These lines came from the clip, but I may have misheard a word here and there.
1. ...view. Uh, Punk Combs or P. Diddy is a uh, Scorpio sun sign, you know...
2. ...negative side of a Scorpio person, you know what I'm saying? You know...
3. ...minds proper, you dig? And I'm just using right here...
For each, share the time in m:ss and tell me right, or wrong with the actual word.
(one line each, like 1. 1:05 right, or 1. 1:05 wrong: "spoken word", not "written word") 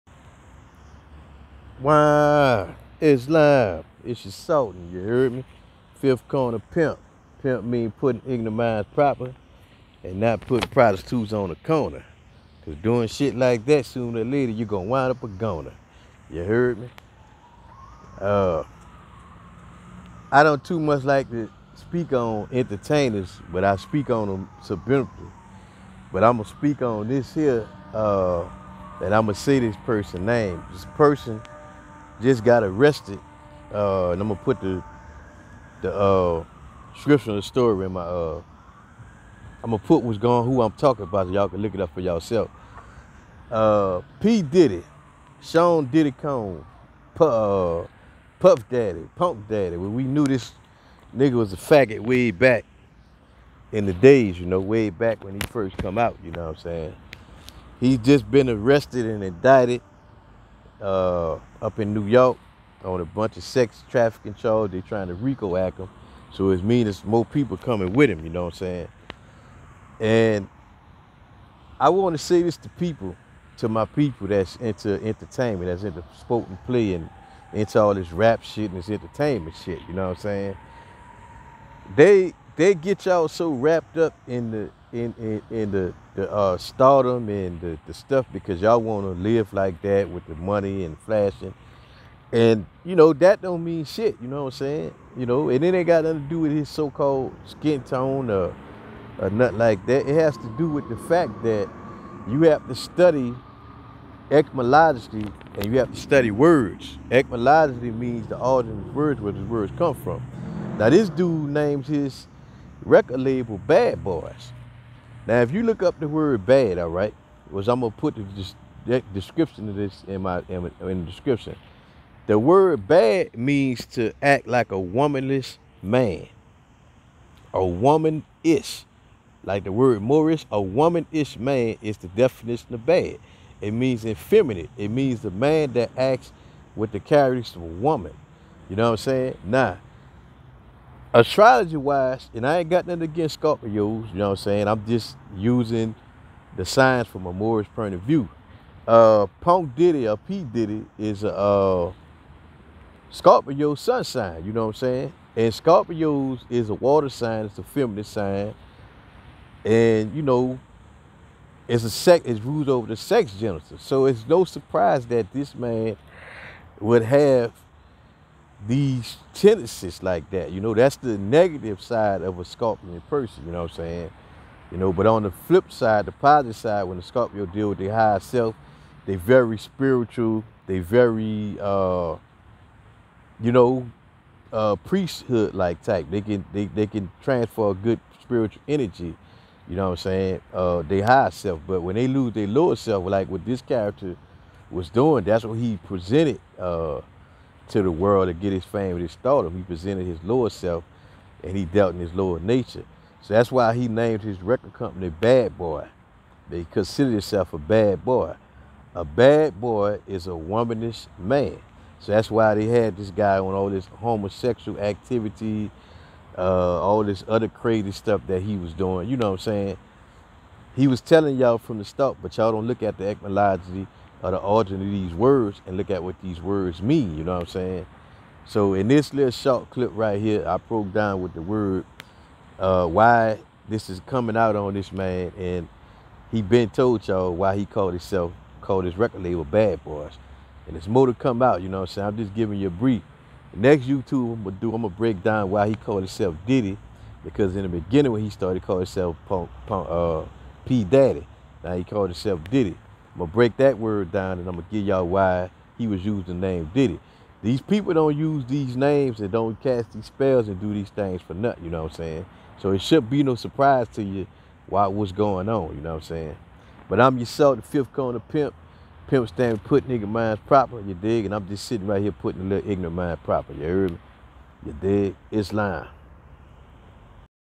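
1. 2:28 wrong: "Diddy", not "Combs"
2. 2:51 right
3. 4:30 wrong: "sitting", not "using".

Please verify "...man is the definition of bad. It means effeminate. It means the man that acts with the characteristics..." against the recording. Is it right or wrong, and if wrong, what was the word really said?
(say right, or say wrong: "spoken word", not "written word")
right.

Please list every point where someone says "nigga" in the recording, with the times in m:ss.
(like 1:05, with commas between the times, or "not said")
0:51, 4:29.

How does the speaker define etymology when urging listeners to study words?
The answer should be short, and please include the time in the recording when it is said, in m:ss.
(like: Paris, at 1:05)
The origin of words, at 1:48.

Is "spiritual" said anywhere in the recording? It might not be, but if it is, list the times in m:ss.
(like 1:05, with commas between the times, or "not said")
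2:59, 3:08.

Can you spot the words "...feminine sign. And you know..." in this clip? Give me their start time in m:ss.
2:37.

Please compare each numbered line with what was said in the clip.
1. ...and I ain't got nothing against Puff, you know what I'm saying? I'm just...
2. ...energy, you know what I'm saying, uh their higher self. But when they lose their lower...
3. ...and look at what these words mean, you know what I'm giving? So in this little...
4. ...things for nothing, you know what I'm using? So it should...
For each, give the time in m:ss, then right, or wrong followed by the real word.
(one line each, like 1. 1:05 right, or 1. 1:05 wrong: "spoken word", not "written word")
1. 2:22 wrong: "Scorpios", not "Puff"
2. 3:08 right
3. 3:45 wrong: "saying", not "giving"
4. 4:20 wrong: "saying", not "using".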